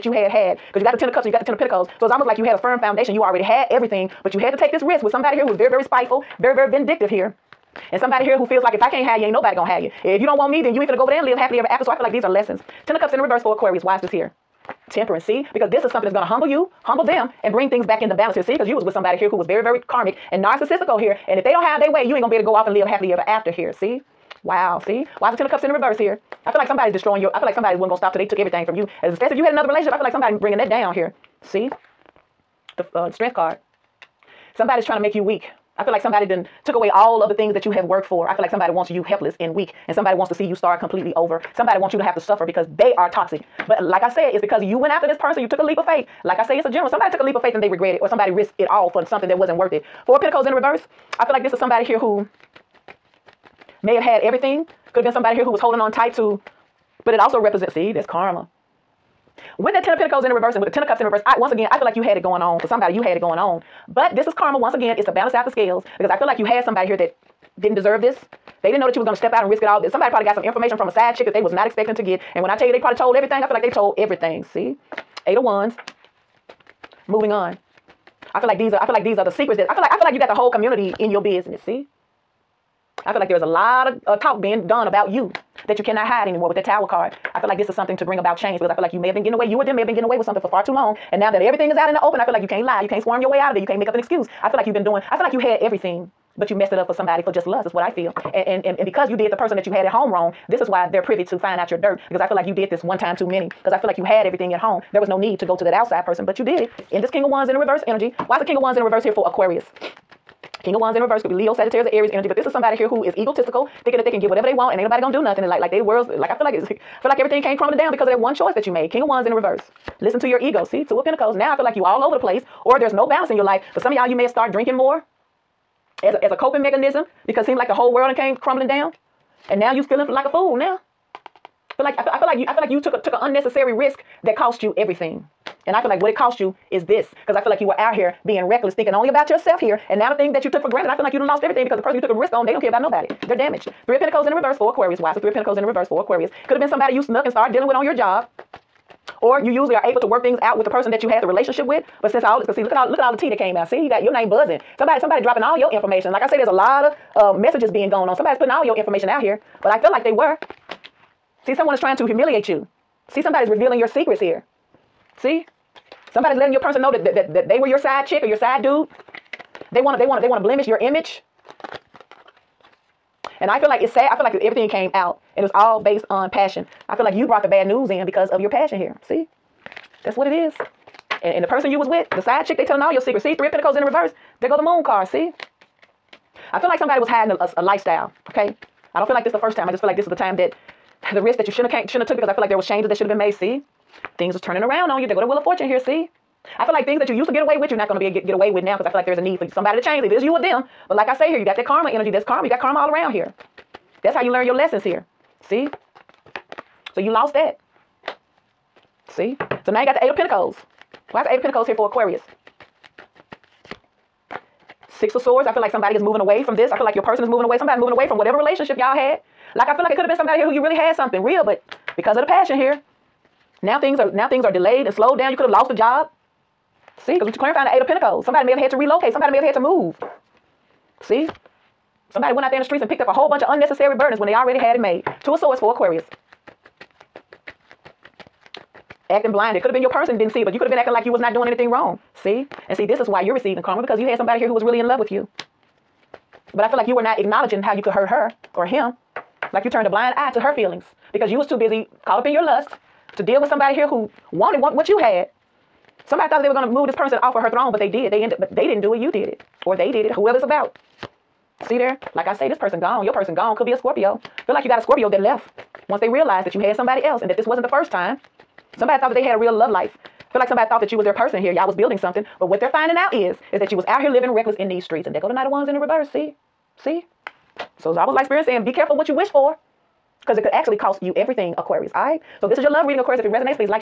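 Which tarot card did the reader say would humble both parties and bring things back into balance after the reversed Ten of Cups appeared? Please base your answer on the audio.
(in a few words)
Temperance.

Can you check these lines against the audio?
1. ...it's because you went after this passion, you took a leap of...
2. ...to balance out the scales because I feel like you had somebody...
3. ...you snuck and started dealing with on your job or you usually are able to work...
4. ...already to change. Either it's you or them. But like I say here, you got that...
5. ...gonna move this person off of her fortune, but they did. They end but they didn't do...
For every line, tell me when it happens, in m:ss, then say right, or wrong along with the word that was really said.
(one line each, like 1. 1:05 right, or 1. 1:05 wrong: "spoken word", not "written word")
1. 0:44 wrong: "person", not "passion"
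2. 1:05 right
3. 2:26 right
4. 3:19 wrong: "somebody", not "already"
5. 4:16 wrong: "throne", not "fortune".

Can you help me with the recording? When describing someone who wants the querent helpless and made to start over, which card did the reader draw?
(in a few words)
Strength.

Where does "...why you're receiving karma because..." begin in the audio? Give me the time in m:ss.
4:03.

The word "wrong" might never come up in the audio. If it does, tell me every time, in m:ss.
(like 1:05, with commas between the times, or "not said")
1:40, 4:01.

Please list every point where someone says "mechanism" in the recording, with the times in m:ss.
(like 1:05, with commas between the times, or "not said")
2:06.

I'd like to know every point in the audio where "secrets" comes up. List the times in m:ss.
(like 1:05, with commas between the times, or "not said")
1:19, 2:43, 3:03.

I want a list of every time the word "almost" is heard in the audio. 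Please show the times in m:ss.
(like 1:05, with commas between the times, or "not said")
0:02, 4:37.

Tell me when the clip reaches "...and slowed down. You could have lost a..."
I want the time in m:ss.
3:44.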